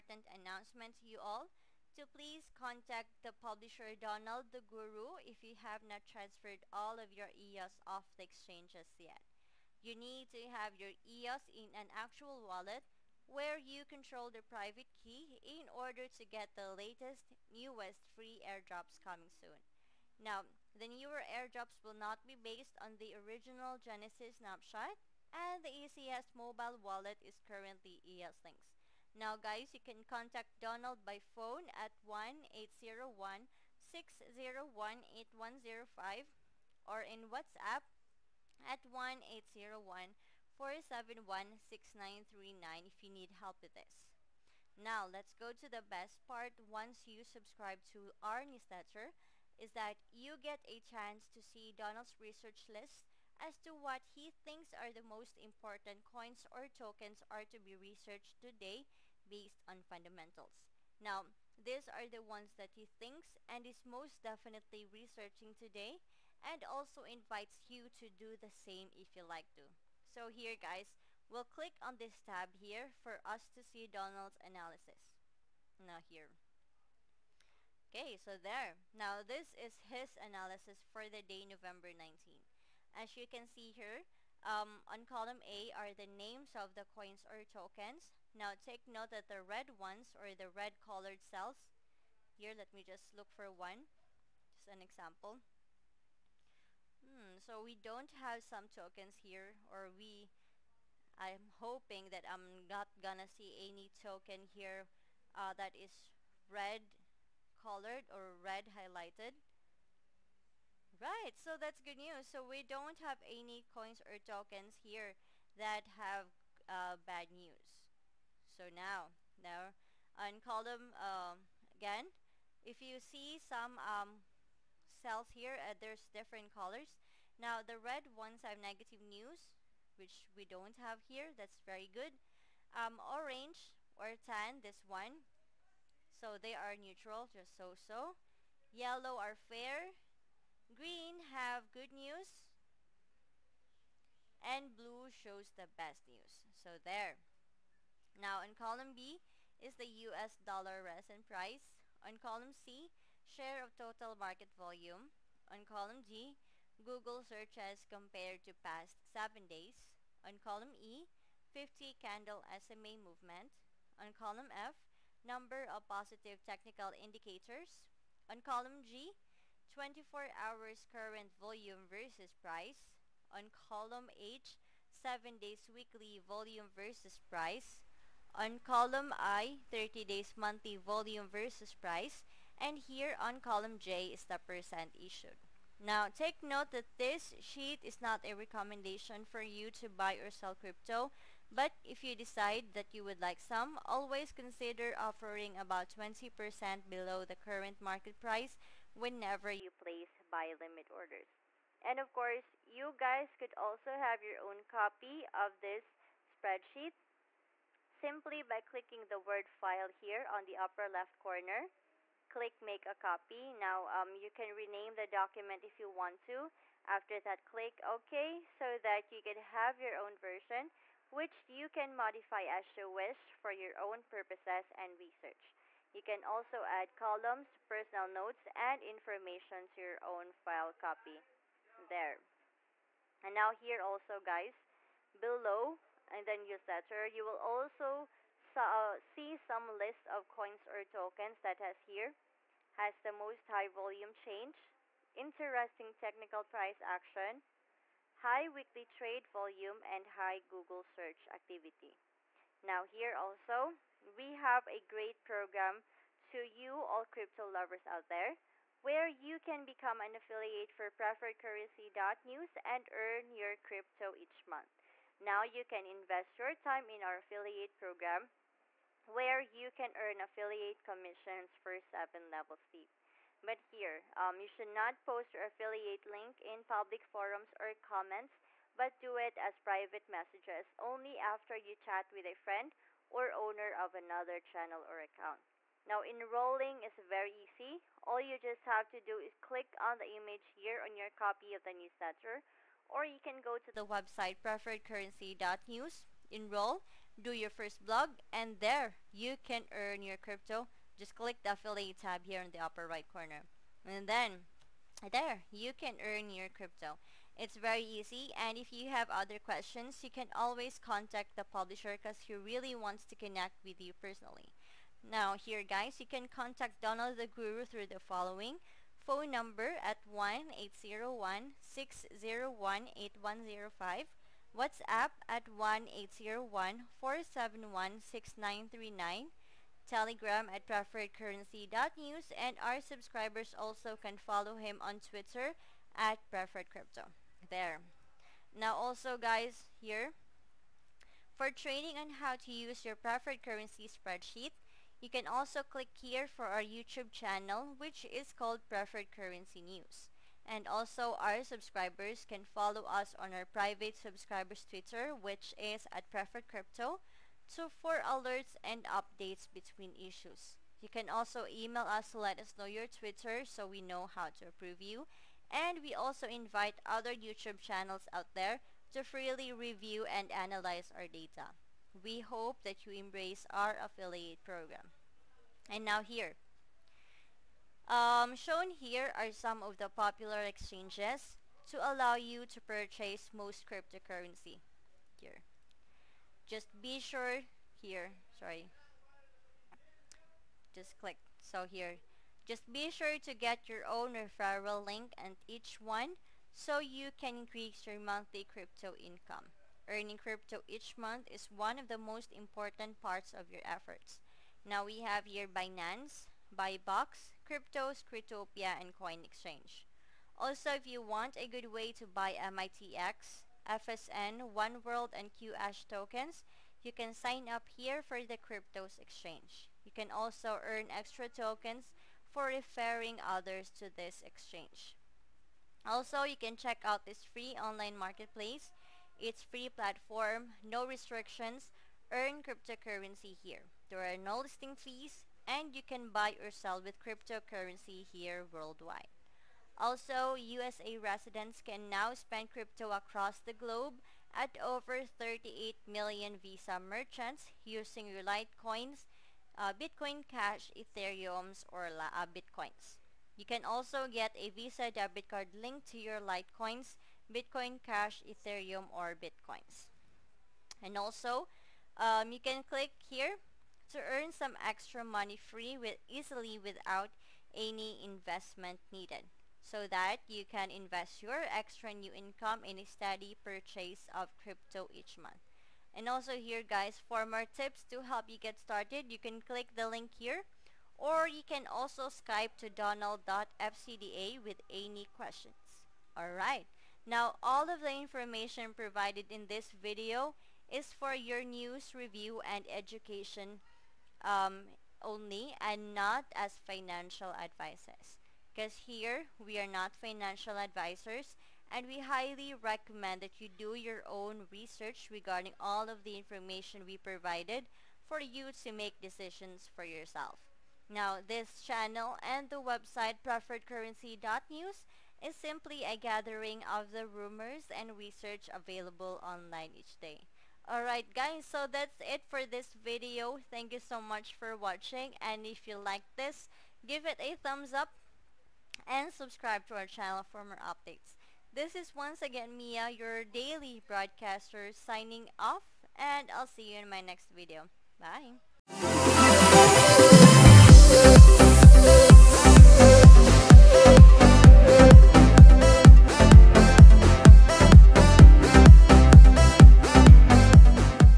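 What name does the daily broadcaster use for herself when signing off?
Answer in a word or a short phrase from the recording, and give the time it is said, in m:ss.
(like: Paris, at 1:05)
Mia, at 8:52.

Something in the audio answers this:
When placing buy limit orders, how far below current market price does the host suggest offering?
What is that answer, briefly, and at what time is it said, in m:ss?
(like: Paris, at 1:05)
20%, at 3:15.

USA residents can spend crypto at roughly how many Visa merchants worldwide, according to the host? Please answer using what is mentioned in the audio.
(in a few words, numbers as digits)
38 million.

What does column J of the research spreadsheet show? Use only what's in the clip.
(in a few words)
Percent issued.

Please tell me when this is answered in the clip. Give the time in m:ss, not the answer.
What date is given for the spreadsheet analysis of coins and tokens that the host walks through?
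1:21.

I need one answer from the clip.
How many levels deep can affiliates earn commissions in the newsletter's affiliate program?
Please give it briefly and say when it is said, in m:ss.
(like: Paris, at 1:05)
7 levels, at 4:31.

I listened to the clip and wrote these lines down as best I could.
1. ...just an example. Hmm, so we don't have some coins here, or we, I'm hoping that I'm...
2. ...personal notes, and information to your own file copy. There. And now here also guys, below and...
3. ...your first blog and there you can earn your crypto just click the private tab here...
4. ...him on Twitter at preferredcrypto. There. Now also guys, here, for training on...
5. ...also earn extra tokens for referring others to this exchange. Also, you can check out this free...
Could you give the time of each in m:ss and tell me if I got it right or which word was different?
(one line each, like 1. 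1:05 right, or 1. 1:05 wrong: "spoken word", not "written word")
1. 1:34 wrong: "tokens", not "coins"
2. 3:47 right
3. 4:57 wrong: "affiliate", not "private"
4. 5:34 right
5. 7:00 right.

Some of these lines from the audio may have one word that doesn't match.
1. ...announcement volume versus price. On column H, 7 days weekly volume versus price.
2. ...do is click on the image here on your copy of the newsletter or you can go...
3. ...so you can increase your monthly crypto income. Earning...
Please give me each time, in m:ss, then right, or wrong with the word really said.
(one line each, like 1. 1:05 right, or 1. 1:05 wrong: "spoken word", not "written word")
1. 2:50 wrong: "current", not "announcement"
2. 4:48 right
3. 6:36 right.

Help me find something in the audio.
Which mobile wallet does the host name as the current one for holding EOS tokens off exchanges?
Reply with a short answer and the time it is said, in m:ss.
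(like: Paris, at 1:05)
EOSlynx, at 0:28.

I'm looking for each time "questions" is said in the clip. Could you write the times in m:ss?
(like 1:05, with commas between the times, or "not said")
5:09, 8:05.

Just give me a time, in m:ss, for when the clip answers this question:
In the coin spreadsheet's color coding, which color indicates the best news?
2:24.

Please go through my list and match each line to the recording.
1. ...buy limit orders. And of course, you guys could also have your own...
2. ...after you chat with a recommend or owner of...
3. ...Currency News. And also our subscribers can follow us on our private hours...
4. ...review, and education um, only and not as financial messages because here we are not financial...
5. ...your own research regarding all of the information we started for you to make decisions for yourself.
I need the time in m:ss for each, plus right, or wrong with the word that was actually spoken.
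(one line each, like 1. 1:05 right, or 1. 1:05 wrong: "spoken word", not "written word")
1. 3:20 right
2. 4:41 wrong: "friend", not "recommend"
3. 5:49 wrong: "subscribers", not "hours"
4. 8:11 wrong: "advices", not "messages"
5. 8:23 wrong: "provided", not "started".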